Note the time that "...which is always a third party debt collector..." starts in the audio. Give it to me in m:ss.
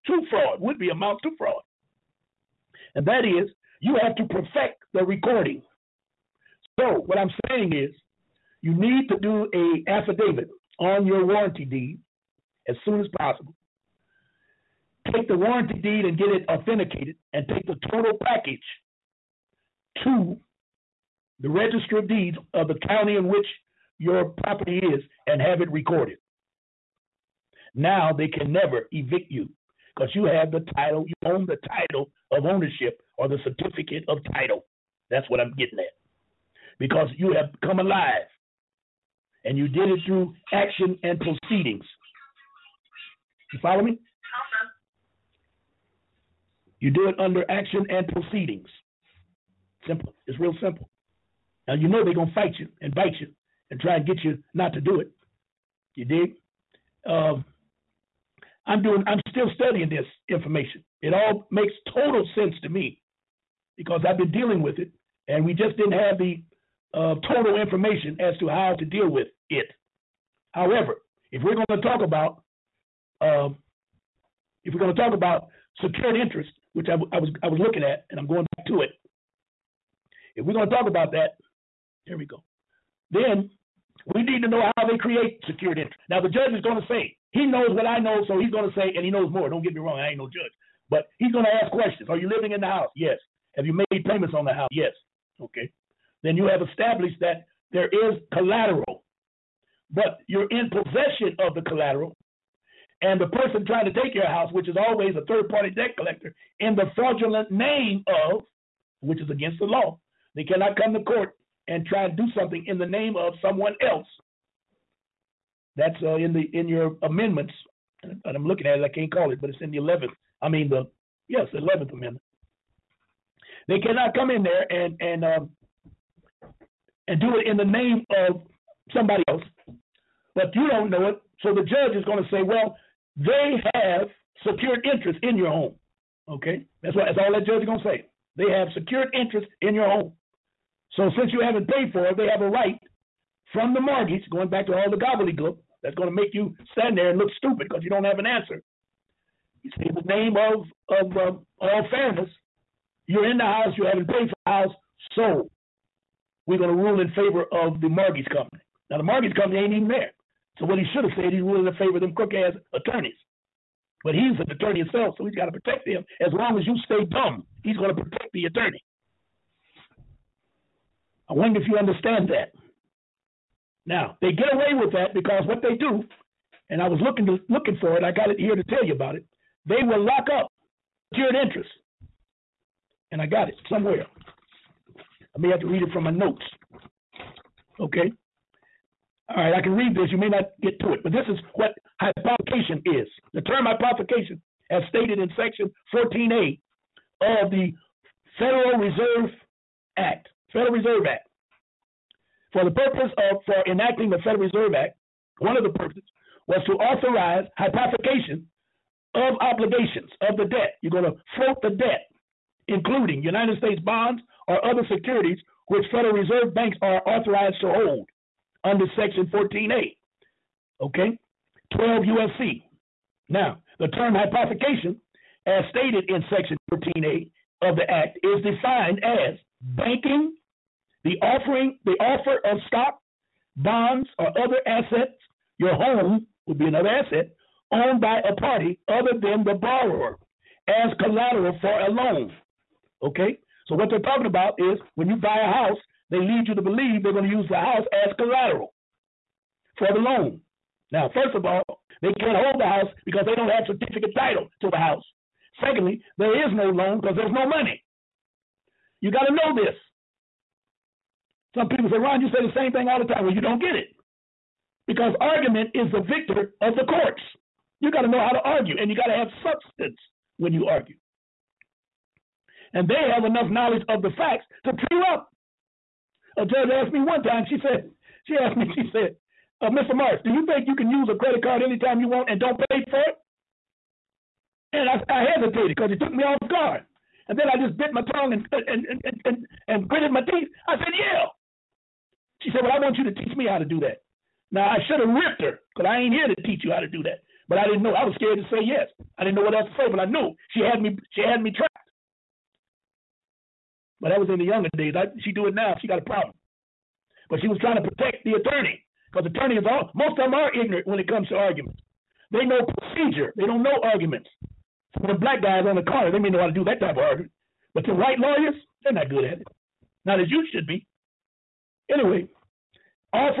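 1:44.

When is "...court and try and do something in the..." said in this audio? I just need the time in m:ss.
1:51.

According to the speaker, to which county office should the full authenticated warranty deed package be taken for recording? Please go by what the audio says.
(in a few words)
Register of deeds.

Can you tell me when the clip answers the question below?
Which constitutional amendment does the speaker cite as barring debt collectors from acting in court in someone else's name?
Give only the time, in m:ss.
2:01.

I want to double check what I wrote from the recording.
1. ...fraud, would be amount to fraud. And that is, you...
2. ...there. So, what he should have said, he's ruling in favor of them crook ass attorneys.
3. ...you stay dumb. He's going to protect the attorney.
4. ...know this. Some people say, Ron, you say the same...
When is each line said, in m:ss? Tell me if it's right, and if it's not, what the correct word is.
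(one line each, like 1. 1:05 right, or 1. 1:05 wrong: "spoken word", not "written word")
1. 0:00 right
2. 2:39 right
3. 2:46 right
4. 4:19 right.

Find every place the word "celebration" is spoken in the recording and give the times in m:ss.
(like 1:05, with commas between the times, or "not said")
not said.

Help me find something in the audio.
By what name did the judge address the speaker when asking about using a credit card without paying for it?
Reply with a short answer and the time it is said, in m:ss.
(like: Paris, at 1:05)
Mr. March, at 4:39.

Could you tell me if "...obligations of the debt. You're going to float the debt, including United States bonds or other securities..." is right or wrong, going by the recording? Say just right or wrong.
right.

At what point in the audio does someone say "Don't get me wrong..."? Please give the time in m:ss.
1:29.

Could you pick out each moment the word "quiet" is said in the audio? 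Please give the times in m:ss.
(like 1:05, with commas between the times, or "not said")
not said.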